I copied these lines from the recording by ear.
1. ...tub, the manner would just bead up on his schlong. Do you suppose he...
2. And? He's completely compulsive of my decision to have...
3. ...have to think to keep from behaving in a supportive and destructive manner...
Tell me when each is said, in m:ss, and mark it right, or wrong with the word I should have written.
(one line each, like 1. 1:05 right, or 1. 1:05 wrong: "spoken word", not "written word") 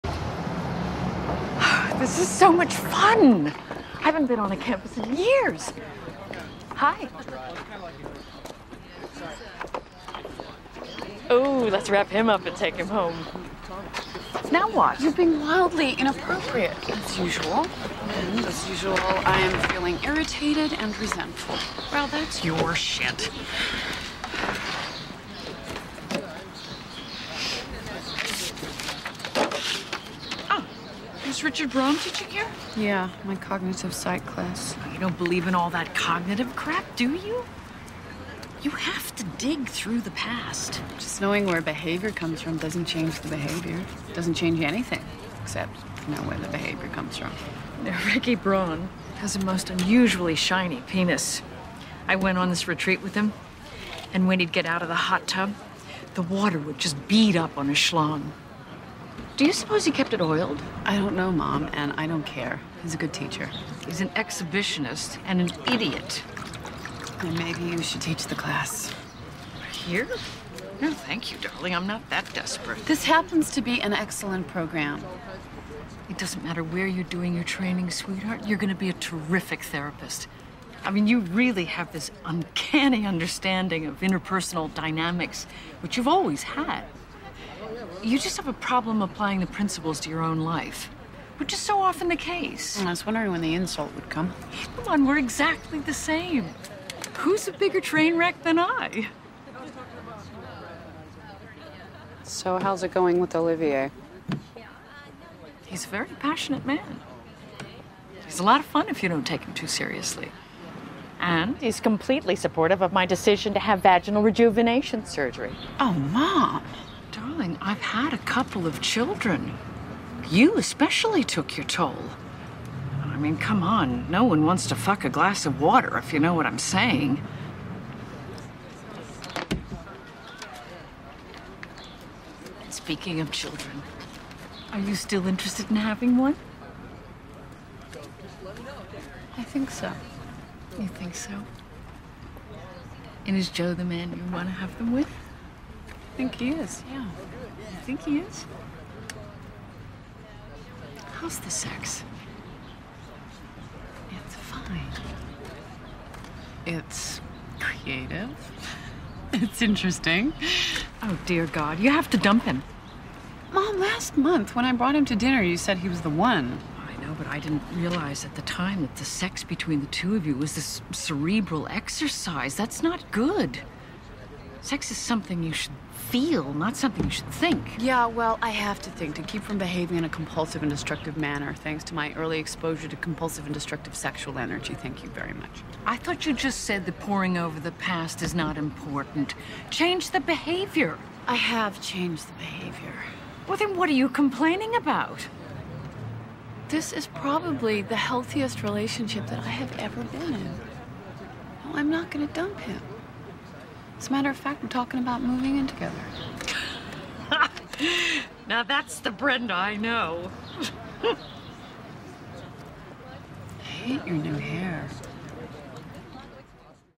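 1. 0:55 wrong: "water", not "manner"
2. 1:51 wrong: "supportive", not "compulsive"
3. 2:58 wrong: "compulsive", not "supportive".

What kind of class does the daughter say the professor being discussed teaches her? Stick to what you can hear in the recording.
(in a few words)
Cognitive psych.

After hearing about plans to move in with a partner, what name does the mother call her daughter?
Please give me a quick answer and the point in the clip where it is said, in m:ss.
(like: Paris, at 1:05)
Brenda, at 3:29.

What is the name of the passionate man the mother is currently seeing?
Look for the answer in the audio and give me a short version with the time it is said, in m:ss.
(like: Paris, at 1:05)
Olivier, at 1:43.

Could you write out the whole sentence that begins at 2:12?
Speaking of children, are you still interested in having one?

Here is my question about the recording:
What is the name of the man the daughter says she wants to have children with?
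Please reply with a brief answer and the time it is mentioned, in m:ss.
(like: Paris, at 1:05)
Joe, at 2:23.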